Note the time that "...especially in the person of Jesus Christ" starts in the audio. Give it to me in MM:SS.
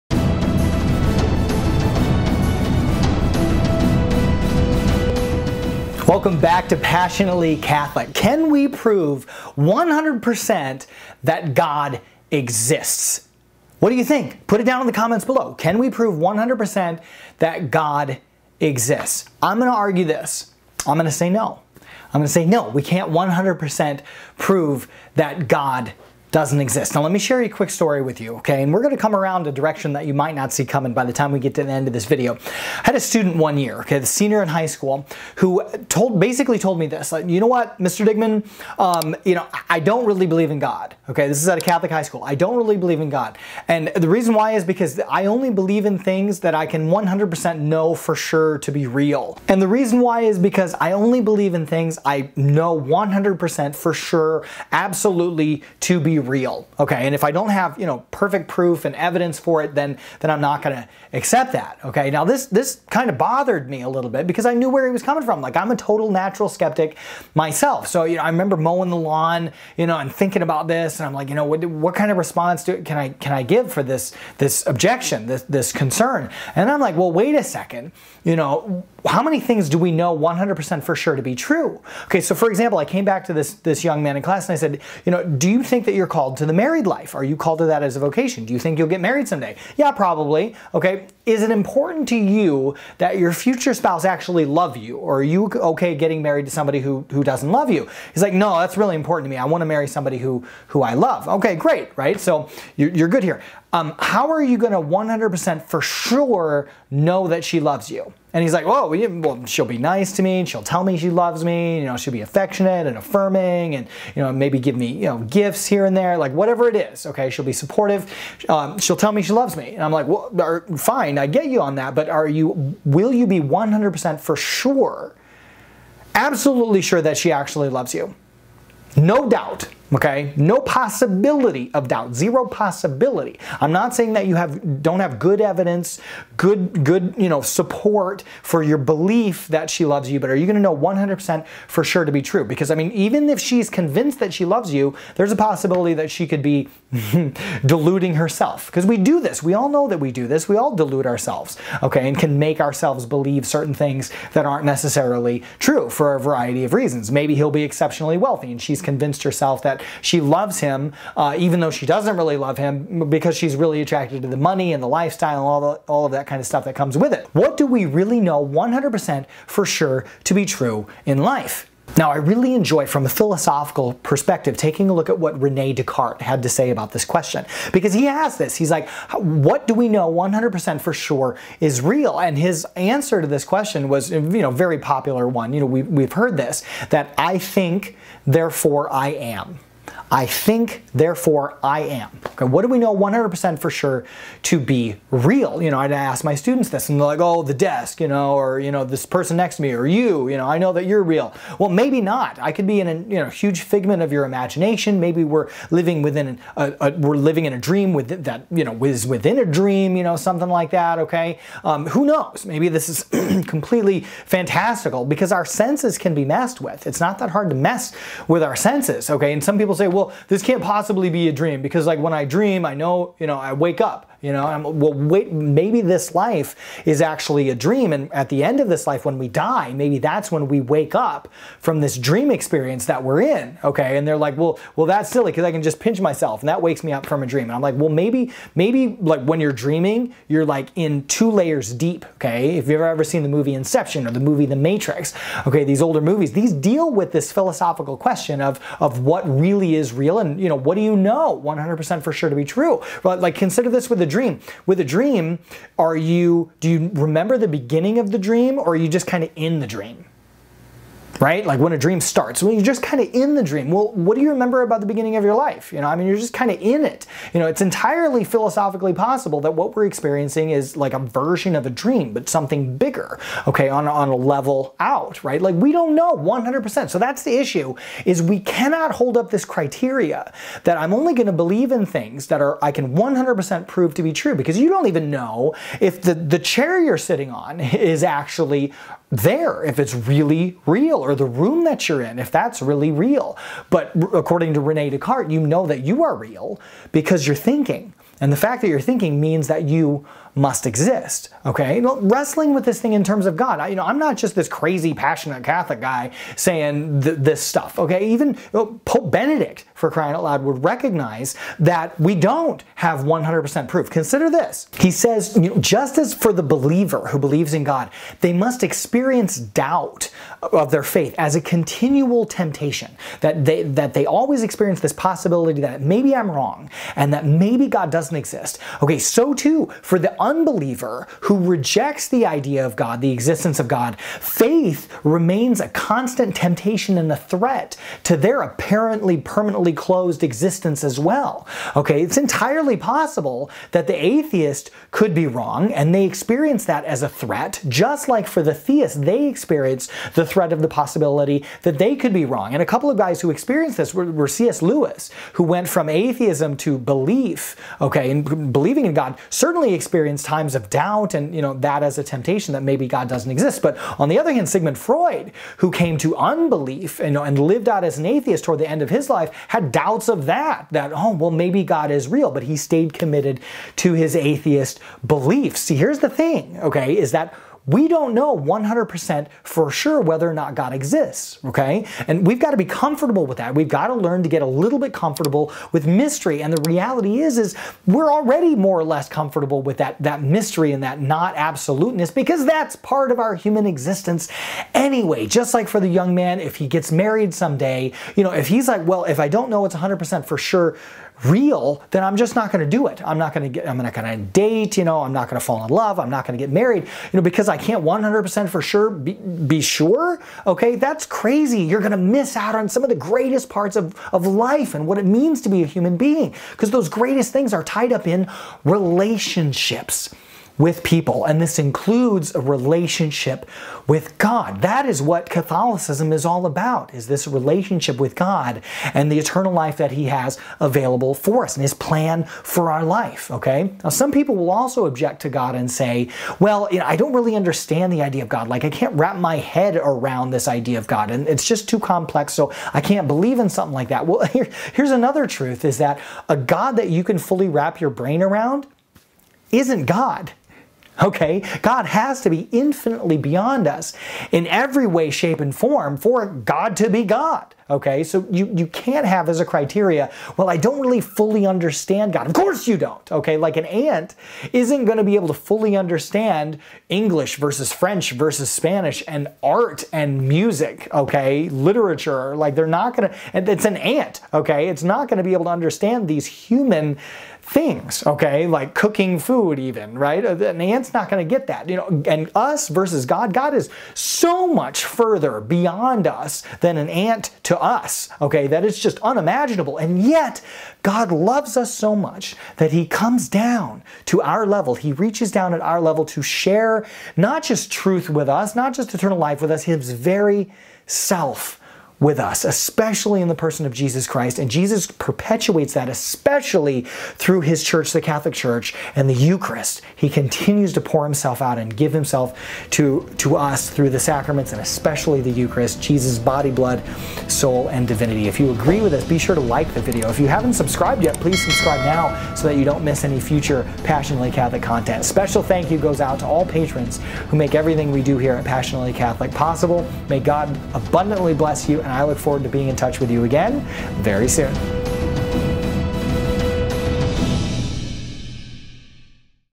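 08:22.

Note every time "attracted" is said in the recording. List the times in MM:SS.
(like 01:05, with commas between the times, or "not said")
02:43.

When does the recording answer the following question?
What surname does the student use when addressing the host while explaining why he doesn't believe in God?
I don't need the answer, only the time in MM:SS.
00:37.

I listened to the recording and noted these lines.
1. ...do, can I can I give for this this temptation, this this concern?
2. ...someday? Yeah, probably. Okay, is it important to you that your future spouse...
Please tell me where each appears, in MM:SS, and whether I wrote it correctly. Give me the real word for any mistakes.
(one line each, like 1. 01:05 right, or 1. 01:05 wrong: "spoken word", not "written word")
1. 01:12 wrong: "objection", not "temptation"
2. 01:29 right.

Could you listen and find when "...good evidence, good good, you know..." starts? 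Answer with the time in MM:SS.
02:15.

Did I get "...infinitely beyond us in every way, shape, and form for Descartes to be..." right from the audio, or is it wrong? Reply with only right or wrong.
wrong.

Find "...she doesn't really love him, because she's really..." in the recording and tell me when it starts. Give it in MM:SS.
02:41.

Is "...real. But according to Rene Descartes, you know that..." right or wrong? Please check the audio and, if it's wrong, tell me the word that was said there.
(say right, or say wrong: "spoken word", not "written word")
right.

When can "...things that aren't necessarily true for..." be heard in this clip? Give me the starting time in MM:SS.
02:33.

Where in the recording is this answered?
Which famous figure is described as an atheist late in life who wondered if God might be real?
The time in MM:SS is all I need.
06:04.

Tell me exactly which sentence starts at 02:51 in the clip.
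Now, I really enjoy, from a philosophical perspective, taking a look at what Rene Descartes had to say about this question.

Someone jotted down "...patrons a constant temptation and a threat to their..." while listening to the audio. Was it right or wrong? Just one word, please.
wrong.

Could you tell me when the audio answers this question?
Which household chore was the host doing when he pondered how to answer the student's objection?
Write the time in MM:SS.
01:08.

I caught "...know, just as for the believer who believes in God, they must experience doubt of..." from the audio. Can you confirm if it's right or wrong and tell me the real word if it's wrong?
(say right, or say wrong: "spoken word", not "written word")
right.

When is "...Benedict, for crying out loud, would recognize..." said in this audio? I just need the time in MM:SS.
05:09.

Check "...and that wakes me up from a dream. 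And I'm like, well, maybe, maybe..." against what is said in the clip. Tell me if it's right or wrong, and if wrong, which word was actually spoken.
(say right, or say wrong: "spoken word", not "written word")
right.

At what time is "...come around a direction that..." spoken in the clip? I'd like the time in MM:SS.
00:28.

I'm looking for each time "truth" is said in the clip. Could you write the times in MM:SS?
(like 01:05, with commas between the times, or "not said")
07:25, 08:17.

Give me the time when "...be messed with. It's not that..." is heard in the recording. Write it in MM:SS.
03:36.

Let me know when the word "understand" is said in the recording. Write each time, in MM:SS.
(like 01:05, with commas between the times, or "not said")
07:17, 07:41, 07:45, 07:55.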